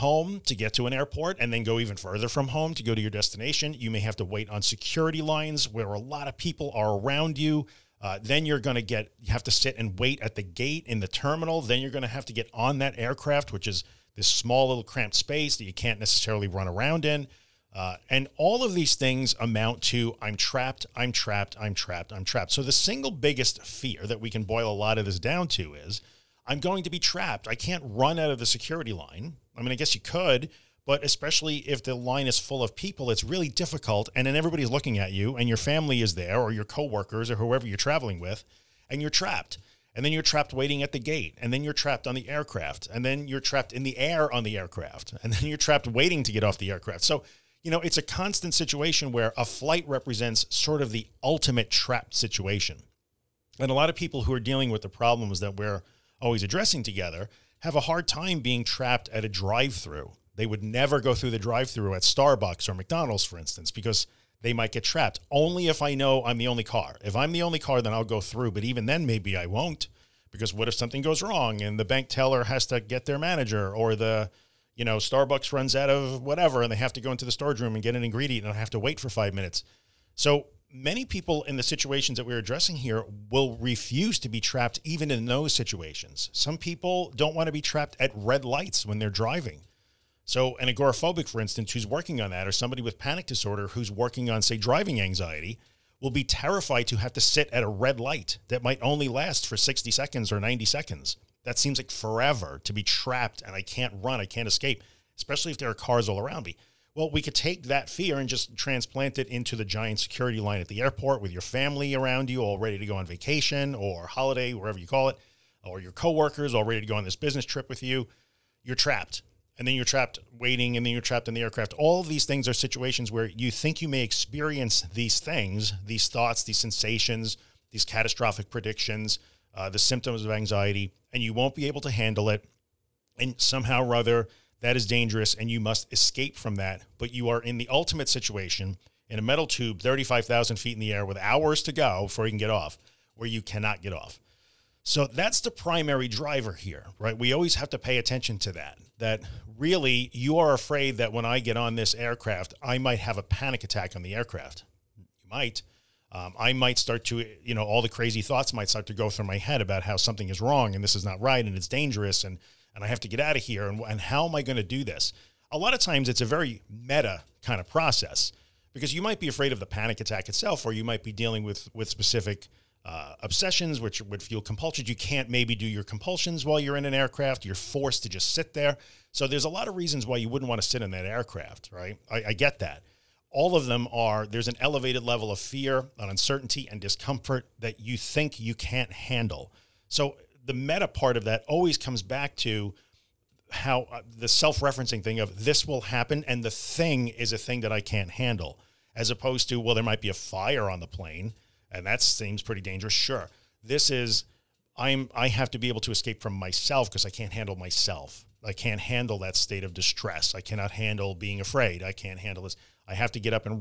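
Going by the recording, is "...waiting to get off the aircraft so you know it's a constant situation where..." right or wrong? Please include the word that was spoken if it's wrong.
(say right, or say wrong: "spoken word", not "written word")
right.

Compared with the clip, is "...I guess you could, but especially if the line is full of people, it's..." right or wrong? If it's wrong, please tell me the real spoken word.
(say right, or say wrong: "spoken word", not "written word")
right.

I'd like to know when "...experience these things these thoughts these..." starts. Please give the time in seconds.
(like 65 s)
124 s.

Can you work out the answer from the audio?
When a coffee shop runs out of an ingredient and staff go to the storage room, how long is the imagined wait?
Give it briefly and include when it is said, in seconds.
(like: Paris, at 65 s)
5 minutes, at 79 s.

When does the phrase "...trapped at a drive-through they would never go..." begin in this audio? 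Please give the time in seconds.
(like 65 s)
58 s.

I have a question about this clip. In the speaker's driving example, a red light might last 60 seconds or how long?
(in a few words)
90 seconds.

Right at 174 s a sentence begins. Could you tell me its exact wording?
You can't maybe do your compulsions while you're in an aircraft.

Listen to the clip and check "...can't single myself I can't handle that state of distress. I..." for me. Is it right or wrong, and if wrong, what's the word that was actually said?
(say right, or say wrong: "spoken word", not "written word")
wrong: "handle", not "single".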